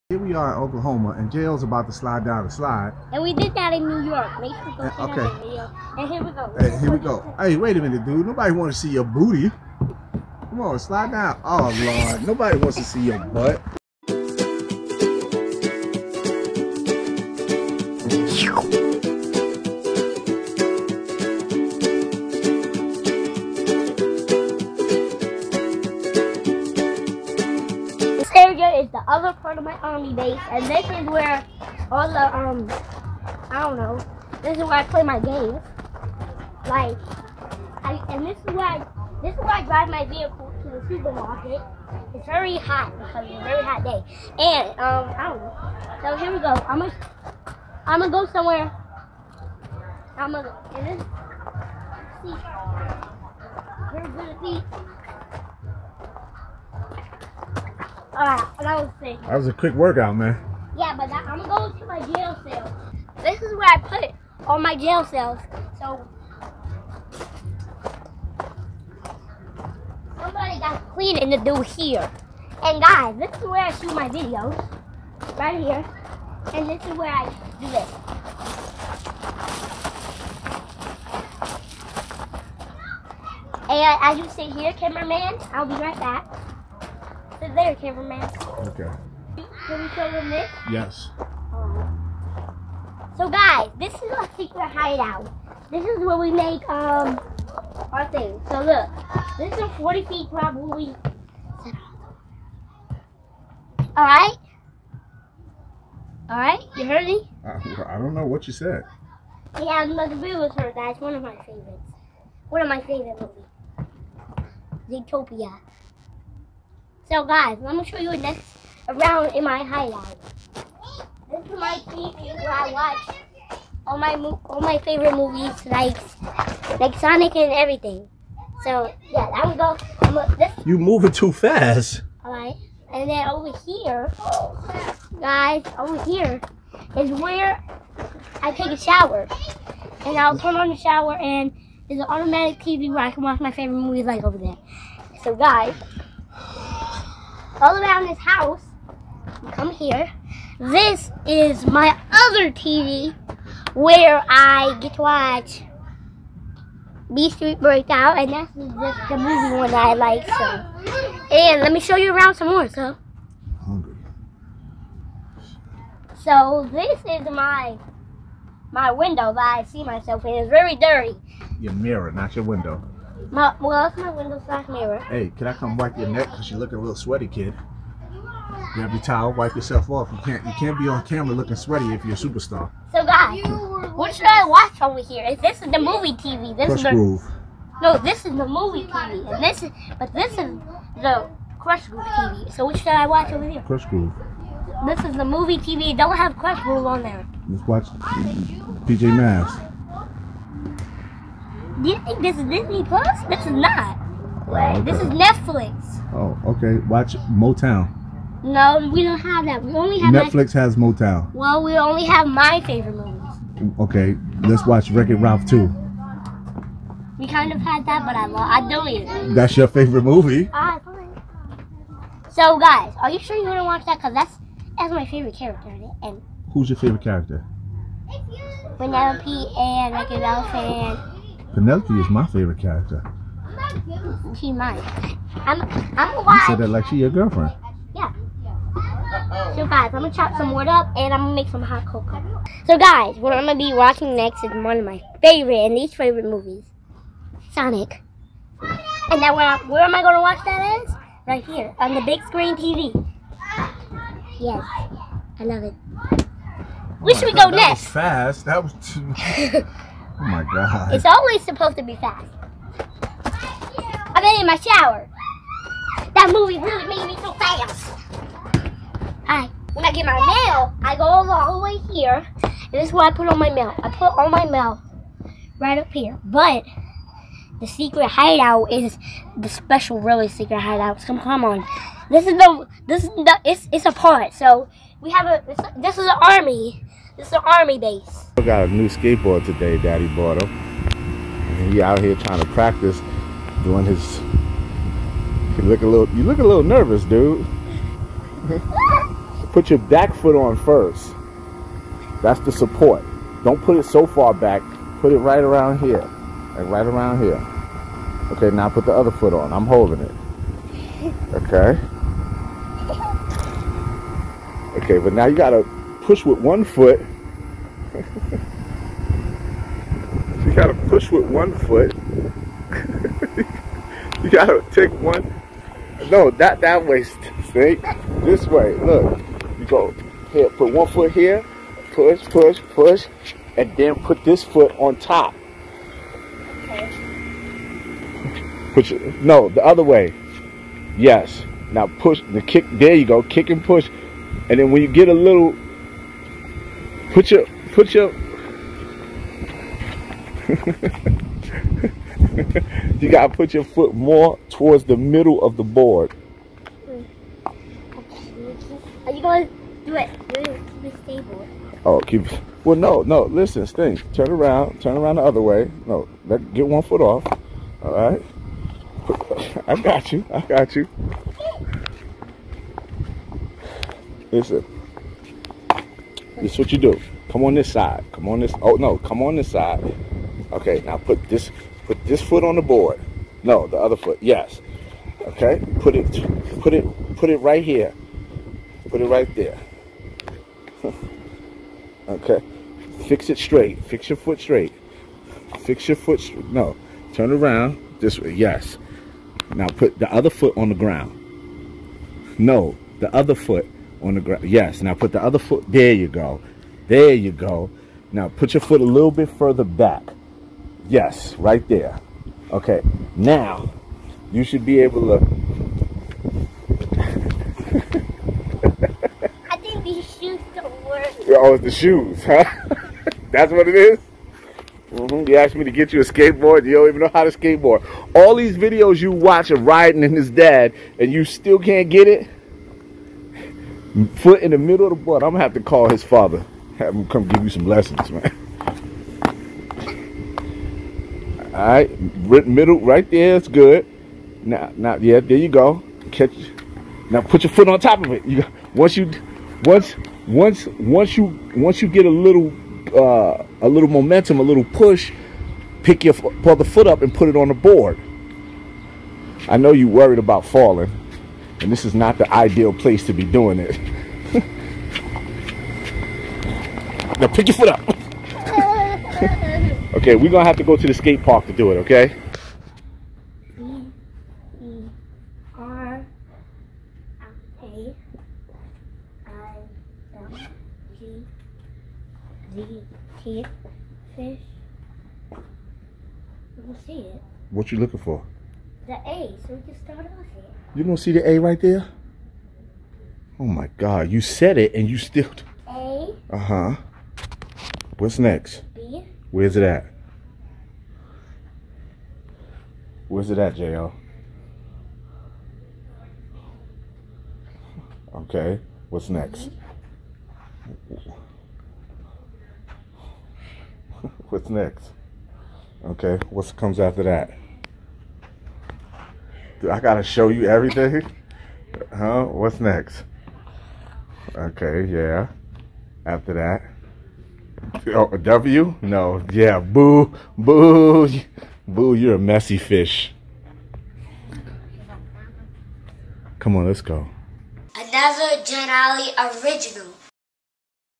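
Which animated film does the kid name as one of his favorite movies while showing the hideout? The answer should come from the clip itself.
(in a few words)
Zootopia.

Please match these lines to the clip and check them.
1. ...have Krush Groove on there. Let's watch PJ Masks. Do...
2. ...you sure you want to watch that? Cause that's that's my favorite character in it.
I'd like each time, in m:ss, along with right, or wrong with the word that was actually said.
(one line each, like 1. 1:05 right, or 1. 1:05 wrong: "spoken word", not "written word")
1. 3:16 right
2. 3:43 right.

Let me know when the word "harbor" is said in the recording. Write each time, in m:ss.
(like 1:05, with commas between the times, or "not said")
not said.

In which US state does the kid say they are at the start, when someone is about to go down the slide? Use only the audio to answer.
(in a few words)
Oklahoma.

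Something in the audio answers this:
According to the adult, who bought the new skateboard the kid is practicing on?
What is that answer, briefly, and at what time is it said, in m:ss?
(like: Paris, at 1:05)
Daddy, at 4:49.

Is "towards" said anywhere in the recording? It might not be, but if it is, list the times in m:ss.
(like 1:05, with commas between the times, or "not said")
5:54.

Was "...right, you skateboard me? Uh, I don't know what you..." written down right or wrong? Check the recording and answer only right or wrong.
wrong.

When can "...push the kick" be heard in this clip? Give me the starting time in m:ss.
5:41.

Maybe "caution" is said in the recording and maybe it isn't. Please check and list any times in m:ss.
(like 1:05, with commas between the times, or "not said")
not said.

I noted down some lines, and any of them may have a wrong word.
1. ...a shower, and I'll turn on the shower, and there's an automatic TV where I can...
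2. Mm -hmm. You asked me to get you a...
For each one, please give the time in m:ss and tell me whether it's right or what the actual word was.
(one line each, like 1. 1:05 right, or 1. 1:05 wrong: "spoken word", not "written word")
1. 2:18 right
2. 7:04 right.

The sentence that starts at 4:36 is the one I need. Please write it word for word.
But the secret hideout is the special, really secret hideout.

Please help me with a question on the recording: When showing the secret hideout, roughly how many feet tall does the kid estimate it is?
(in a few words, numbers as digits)
40.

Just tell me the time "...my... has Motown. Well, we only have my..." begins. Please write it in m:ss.
3:30.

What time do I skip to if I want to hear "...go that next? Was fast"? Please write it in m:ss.
4:17.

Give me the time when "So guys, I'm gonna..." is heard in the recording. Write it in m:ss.
3:59.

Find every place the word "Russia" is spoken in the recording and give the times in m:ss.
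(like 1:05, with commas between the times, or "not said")
not said.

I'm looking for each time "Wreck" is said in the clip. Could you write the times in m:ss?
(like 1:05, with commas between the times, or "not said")
3:34, 3:49.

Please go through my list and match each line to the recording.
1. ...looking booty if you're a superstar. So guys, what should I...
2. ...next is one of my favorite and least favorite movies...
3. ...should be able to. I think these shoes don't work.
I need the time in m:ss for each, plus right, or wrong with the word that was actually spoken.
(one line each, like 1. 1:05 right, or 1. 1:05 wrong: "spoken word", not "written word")
1. 3:01 wrong: "sweaty", not "booty"
2. 4:04 right
3. 6:54 right.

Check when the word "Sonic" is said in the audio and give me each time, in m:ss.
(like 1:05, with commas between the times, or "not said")
2:06, 4:07.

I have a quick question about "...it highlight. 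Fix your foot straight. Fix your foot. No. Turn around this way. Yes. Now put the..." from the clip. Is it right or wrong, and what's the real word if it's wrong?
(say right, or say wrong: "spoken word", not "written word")
wrong: "straight", not "highlight".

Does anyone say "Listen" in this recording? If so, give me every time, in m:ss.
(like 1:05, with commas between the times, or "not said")
6:03, 6:14.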